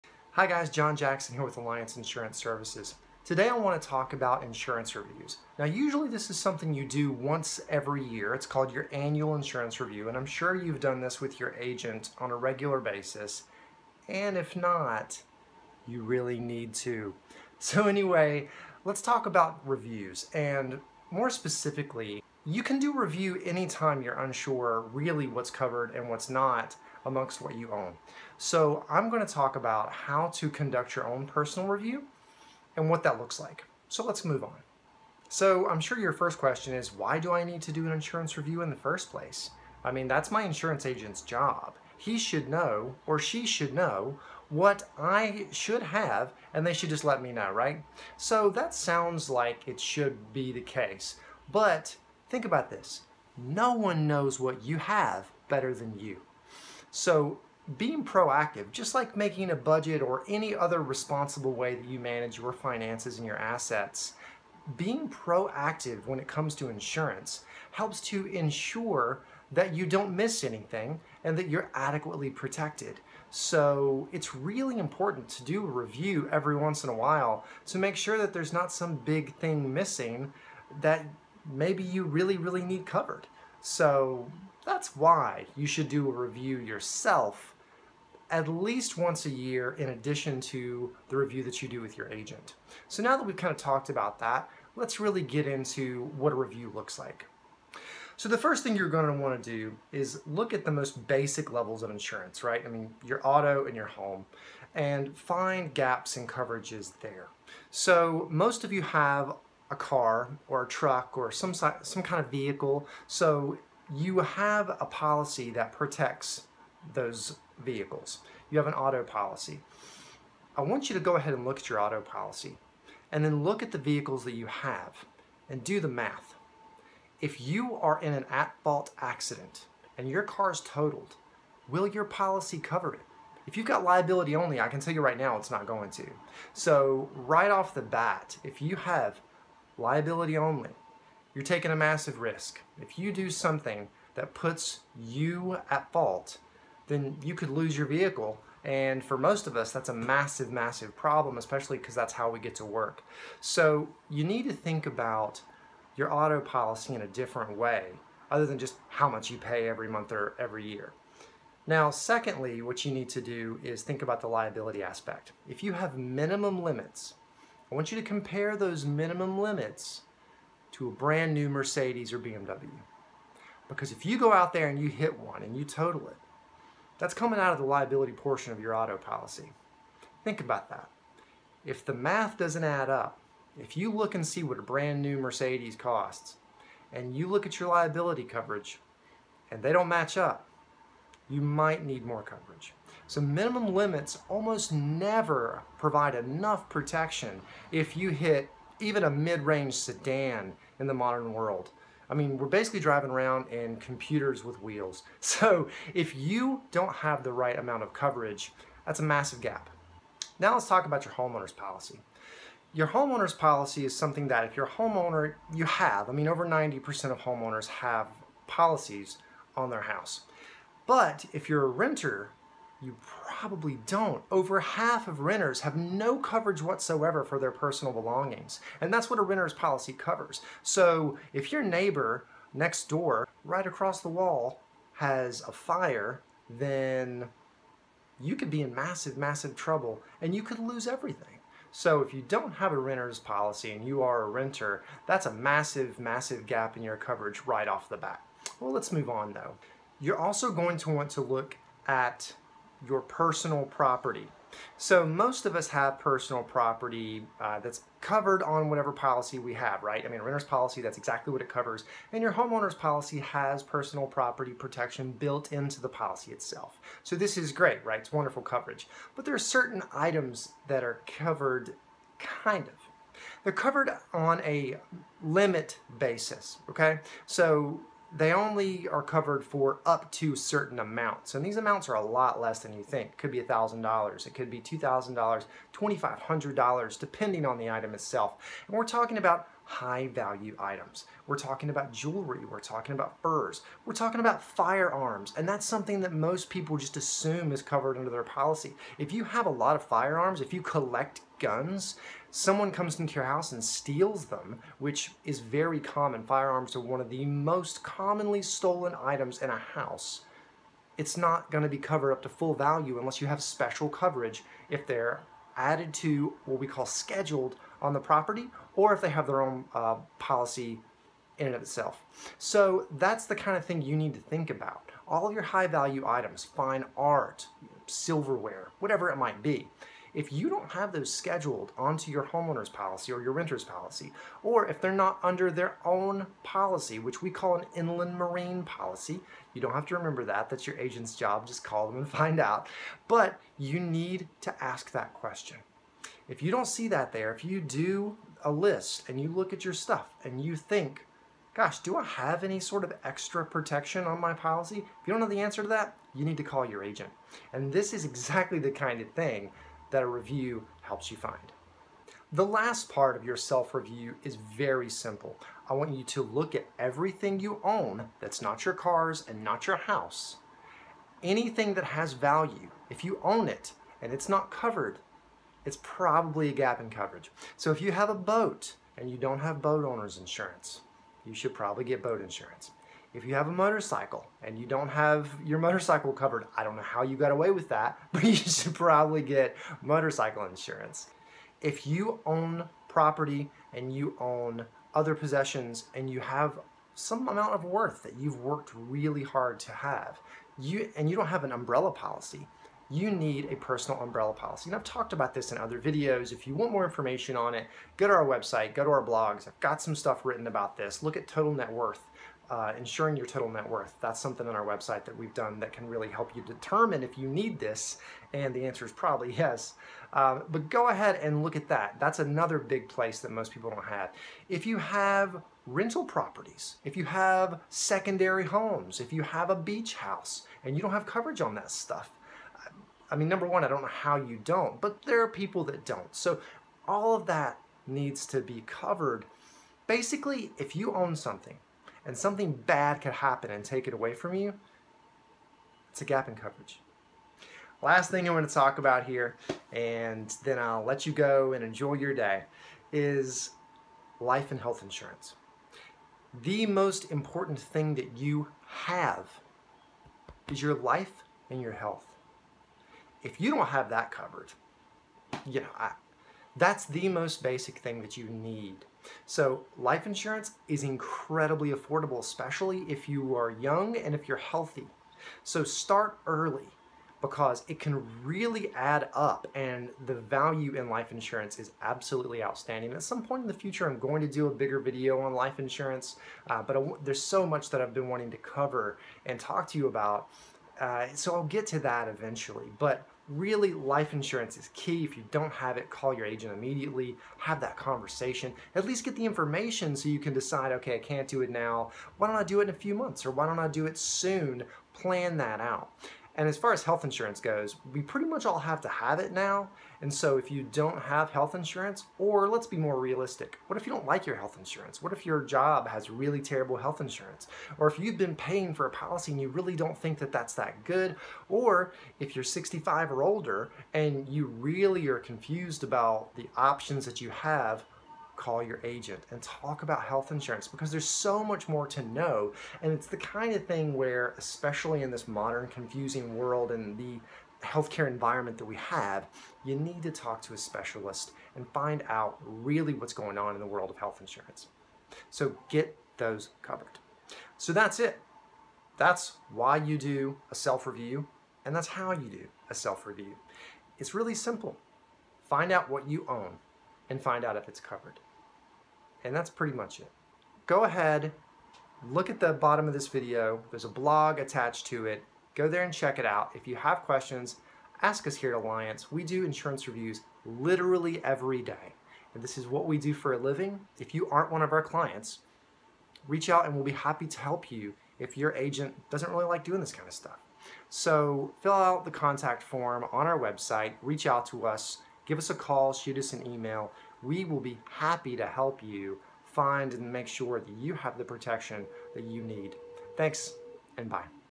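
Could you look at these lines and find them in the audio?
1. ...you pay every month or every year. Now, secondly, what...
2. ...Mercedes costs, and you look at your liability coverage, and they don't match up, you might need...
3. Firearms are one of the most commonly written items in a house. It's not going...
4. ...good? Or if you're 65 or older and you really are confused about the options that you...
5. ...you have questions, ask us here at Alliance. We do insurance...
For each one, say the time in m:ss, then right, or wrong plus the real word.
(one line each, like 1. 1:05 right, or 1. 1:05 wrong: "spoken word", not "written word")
1. 2:39 right
2. 3:05 right
3. 5:06 wrong: "stolen", not "written"
4. 8:40 right
5. 9:26 right.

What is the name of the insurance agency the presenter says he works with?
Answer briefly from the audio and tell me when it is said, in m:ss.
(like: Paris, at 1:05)
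Alliance Insurance Services, at 0:01.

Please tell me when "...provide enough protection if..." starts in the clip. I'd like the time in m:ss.
3:15.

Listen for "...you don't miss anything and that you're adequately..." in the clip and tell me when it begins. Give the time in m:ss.
1:09.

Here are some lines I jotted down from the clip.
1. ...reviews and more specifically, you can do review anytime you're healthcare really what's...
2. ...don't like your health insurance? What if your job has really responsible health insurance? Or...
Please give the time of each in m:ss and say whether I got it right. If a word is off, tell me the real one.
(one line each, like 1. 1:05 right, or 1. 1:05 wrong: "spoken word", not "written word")
1. 0:19 wrong: "unsure", not "healthcare"
2. 8:33 wrong: "terrible", not "responsible".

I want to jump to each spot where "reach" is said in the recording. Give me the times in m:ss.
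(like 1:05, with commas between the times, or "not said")
9:36, 9:44.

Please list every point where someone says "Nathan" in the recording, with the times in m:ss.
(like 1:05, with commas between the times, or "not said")
not said.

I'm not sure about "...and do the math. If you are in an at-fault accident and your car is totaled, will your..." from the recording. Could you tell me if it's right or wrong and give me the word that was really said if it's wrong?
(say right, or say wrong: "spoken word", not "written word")
right.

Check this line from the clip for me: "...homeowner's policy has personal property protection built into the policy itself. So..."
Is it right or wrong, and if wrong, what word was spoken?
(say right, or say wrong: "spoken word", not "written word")
right.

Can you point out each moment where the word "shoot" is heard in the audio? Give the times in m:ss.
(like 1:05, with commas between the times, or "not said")
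9:45.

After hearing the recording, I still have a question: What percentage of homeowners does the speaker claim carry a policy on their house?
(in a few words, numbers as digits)
over 90%.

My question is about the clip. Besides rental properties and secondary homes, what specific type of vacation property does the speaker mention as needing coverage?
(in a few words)
beach house.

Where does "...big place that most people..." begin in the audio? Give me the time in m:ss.
7:02.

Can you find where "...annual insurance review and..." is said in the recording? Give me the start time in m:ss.
0:08.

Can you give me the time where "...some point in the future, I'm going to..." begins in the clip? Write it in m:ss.
8:03.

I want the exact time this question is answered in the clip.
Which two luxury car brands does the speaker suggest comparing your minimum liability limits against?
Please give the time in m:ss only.
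2:51.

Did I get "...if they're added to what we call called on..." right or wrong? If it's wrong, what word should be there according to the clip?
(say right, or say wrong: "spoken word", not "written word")
wrong: "scheduled", not "called".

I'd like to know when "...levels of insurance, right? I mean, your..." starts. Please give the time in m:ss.
1:41.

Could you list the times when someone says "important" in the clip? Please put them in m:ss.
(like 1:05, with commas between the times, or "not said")
1:14, 7:37.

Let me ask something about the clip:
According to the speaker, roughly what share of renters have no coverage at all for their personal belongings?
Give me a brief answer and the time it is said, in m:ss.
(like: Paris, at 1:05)
over half, at 3:44.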